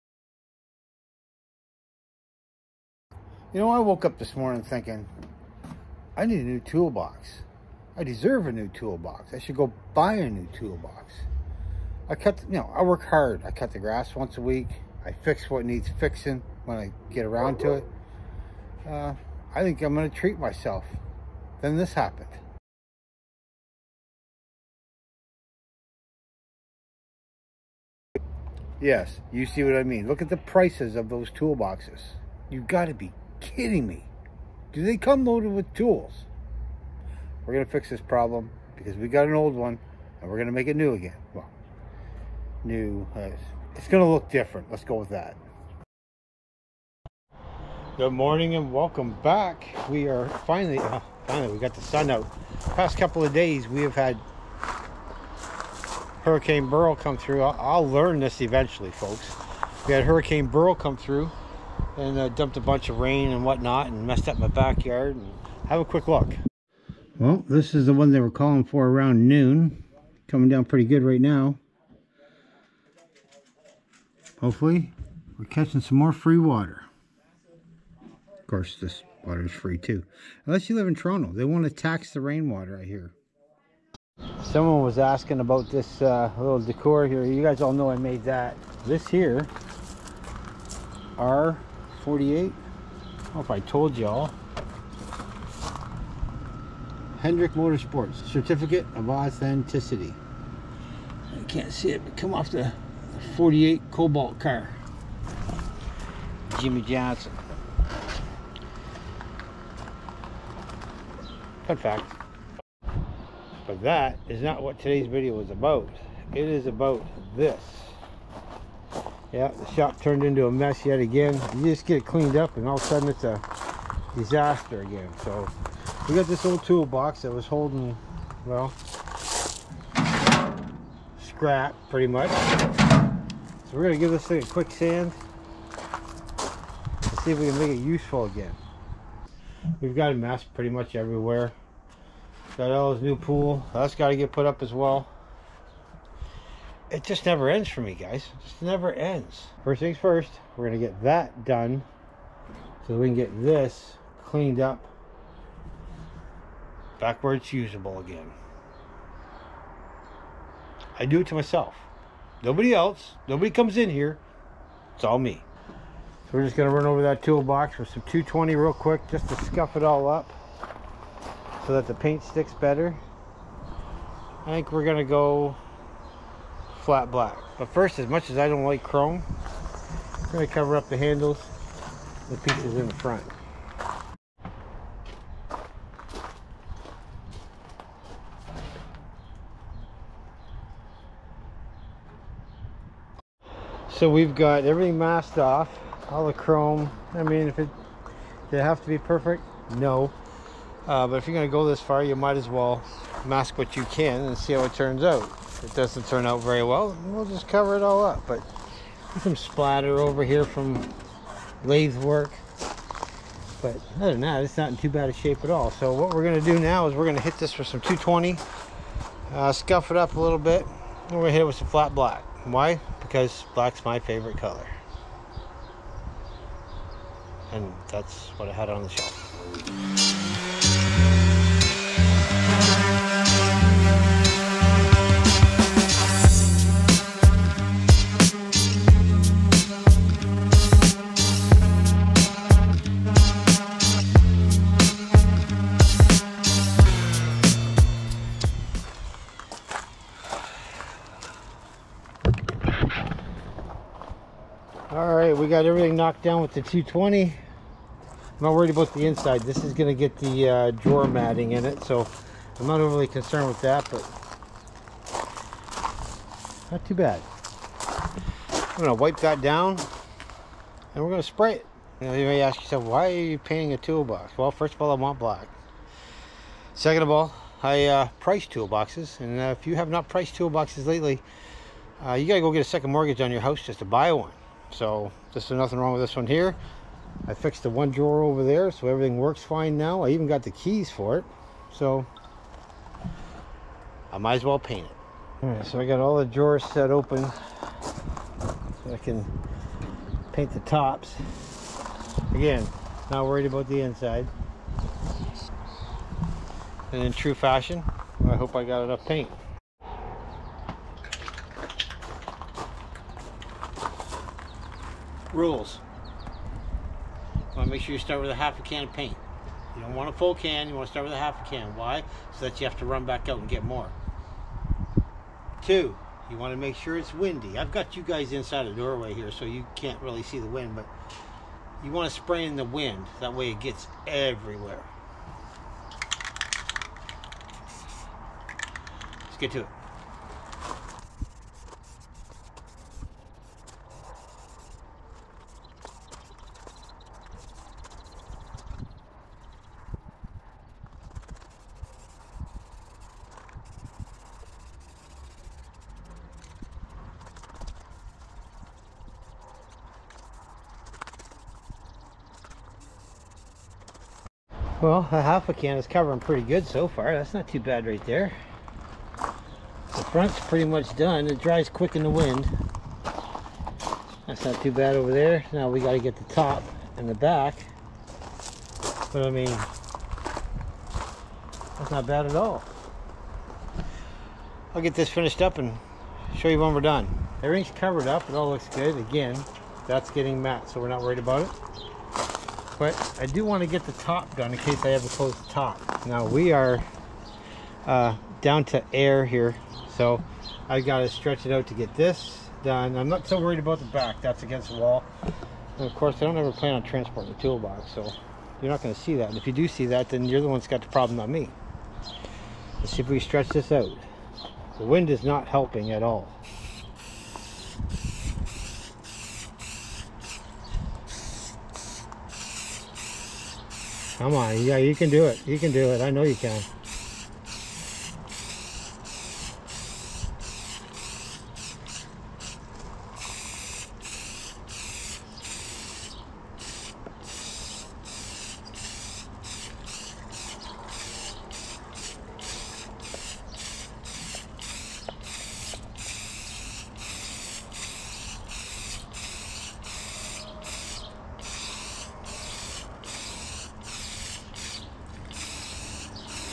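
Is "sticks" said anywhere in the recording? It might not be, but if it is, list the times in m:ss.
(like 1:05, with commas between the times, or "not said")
2:52.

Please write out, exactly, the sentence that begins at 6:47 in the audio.
So you're not going to see that.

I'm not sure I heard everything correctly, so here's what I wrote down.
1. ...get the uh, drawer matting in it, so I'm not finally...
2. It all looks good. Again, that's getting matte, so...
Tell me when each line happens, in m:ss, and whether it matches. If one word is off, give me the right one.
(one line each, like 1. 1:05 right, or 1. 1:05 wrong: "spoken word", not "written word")
1. 4:19 wrong: "overly", not "finally"
2. 6:28 right.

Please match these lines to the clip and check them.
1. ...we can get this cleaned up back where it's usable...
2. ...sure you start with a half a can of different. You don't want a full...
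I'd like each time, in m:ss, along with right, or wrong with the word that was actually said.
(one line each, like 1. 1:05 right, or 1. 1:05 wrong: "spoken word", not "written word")
1. 2:32 right
2. 5:17 wrong: "paint", not "different".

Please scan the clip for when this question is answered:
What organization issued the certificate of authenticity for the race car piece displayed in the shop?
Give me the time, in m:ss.
1:37.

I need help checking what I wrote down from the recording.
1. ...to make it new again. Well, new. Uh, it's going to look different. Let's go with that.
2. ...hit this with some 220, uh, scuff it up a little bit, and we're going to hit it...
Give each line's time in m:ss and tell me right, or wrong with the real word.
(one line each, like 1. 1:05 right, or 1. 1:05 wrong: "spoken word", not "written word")
1. 0:40 right
2. 3:37 right.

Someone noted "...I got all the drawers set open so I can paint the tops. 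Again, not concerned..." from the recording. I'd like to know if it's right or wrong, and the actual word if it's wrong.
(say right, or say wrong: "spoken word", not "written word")
wrong: "worried", not "concerned".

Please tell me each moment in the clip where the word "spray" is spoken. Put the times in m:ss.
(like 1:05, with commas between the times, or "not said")
4:31, 5:32.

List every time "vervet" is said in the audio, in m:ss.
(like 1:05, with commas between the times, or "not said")
not said.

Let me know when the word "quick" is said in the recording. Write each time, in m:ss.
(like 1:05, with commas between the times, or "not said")
1:05, 2:14, 2:48, 6:11.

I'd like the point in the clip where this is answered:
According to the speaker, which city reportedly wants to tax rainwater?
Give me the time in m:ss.
1:20.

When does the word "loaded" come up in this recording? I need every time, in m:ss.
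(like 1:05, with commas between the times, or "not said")
0:35.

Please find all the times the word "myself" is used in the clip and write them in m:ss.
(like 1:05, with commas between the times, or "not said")
0:20, 2:41.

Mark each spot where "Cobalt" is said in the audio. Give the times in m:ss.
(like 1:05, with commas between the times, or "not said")
1:43.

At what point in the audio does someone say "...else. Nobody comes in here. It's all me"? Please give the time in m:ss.
2:42.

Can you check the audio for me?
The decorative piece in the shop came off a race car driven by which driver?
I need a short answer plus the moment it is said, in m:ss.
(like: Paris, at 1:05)
Jimmie Johnson, at 1:46.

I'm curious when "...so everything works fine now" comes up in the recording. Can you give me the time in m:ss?
4:48.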